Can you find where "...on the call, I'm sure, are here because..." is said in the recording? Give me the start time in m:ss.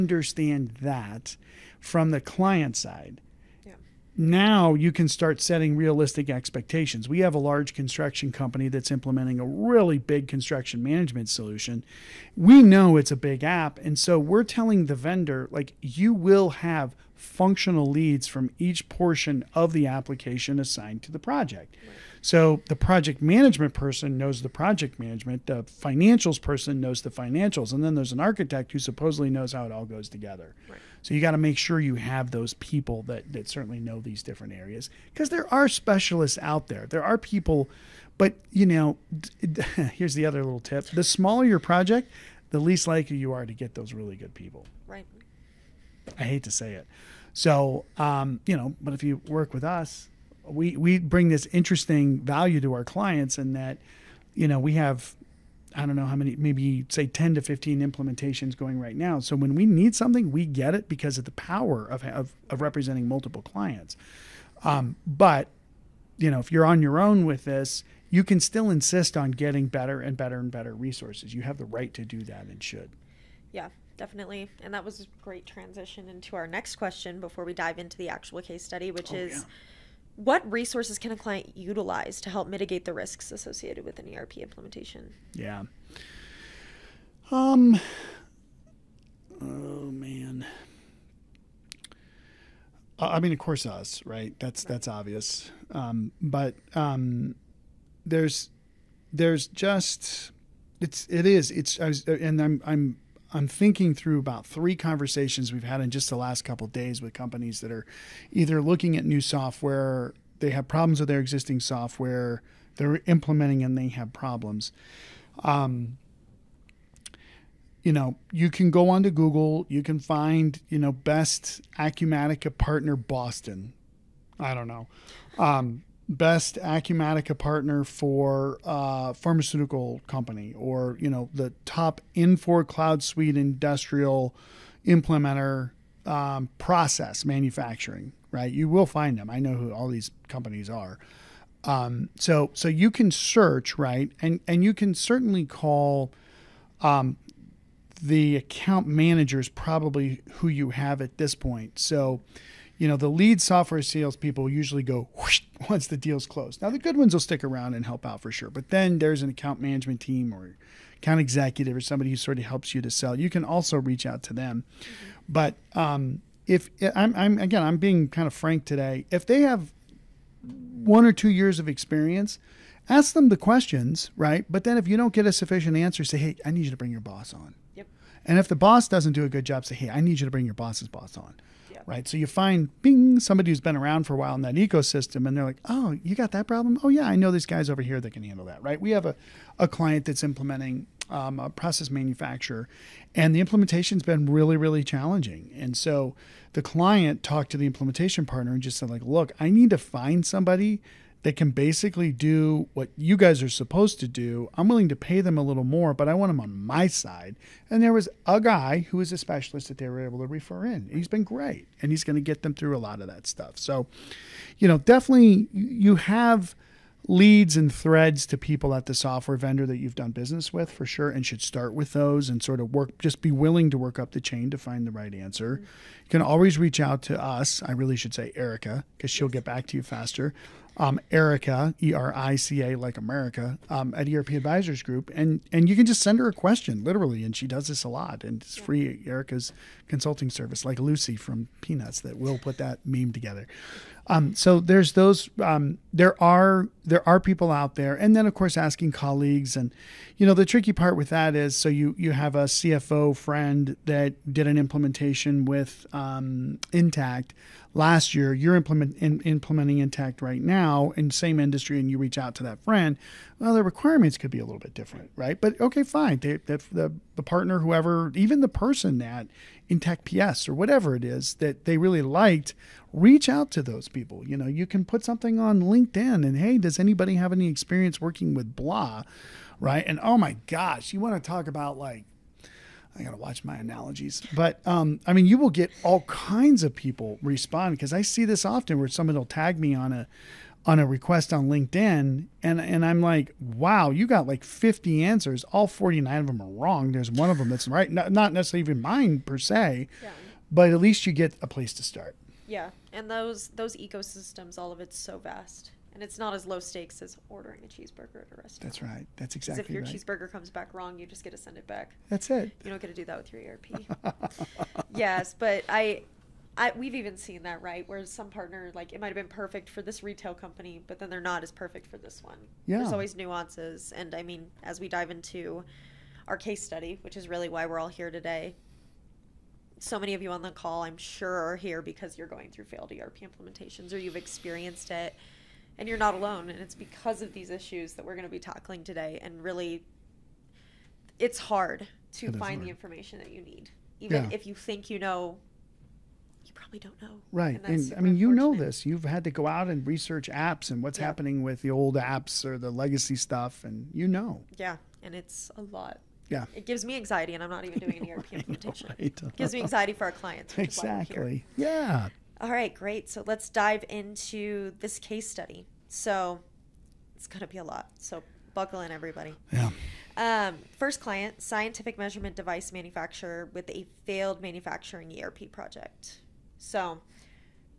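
5:30.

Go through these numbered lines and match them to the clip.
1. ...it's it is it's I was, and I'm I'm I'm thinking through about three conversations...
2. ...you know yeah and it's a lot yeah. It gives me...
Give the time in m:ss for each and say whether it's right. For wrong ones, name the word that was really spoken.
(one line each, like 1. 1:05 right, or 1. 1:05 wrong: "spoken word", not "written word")
1. 1:40 right
2. 5:53 right.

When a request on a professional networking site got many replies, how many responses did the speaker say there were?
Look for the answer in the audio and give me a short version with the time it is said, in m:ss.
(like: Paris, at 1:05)
50, at 4:54.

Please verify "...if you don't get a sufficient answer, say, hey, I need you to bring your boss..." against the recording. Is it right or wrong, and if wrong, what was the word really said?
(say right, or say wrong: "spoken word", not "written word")
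right.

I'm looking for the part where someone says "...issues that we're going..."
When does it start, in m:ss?
5:37.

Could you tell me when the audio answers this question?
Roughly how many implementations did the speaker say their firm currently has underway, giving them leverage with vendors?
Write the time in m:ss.
0:57.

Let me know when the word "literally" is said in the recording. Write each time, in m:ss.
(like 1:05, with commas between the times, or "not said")
3:56.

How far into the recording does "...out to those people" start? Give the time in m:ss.
4:33.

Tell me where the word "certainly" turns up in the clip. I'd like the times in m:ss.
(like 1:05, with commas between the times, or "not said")
0:33, 2:24.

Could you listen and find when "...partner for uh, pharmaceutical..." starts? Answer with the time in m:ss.
2:07.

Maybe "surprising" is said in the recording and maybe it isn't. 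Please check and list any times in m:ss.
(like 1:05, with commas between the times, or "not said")
not said.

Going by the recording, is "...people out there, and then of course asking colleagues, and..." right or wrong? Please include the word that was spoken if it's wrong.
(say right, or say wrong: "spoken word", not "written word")
right.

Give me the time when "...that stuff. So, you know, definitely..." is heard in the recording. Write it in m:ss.
3:33.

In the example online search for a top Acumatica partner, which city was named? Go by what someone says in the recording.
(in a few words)
Boston.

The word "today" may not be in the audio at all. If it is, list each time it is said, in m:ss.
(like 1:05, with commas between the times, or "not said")
2:48, 5:28, 5:38.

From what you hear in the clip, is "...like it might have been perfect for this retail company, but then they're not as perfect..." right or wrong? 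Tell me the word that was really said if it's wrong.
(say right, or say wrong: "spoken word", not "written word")
right.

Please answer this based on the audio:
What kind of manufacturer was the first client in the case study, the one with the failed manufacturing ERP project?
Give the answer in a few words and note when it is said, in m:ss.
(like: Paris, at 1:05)
Scientific measurement device manufacturer, at 6:11.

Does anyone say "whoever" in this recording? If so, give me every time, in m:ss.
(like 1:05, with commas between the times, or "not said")
4:27.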